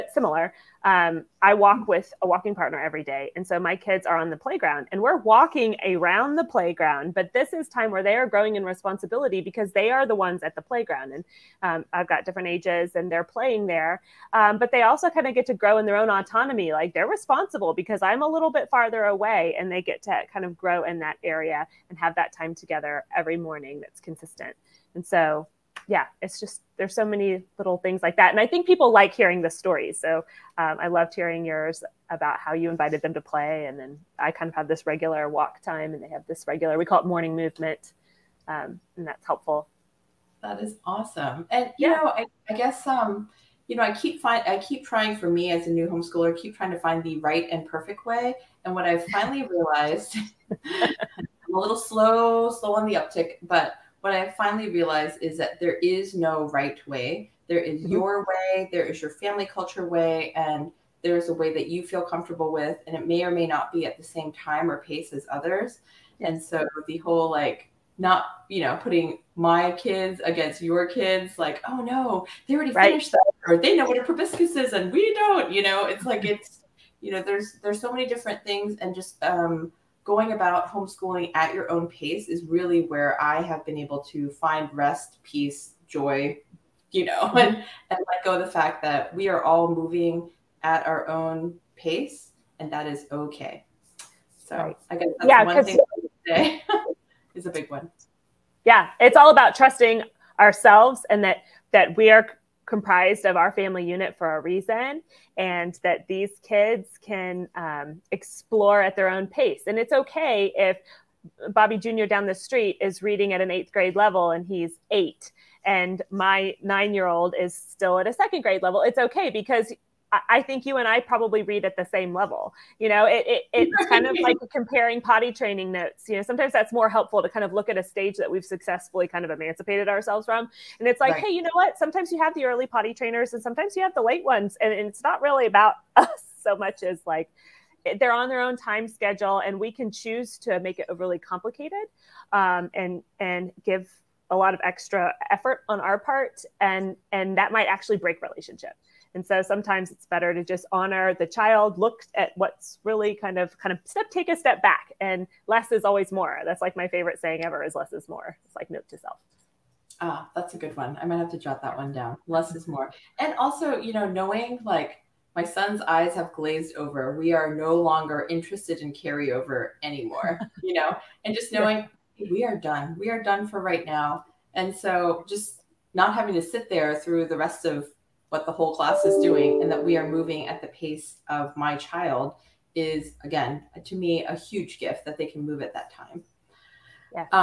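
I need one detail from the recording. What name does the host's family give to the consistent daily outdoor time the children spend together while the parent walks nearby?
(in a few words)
morning movement.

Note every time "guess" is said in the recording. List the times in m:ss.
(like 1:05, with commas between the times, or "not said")
0:42, 1:34.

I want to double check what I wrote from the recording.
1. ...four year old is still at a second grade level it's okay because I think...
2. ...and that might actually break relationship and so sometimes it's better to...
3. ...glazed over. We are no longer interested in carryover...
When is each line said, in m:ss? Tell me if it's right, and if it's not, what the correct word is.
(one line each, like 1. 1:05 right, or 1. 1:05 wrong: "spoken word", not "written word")
1. 1:56 wrong: "nine", not "four"
2. 2:27 right
3. 2:46 right.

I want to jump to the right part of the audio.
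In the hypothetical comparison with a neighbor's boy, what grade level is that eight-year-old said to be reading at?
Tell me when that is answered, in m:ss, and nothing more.
1:53.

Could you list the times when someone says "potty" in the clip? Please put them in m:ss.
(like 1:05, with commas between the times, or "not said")
2:05, 2:12.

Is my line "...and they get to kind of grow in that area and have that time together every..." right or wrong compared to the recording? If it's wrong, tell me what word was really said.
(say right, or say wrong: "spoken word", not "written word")
right.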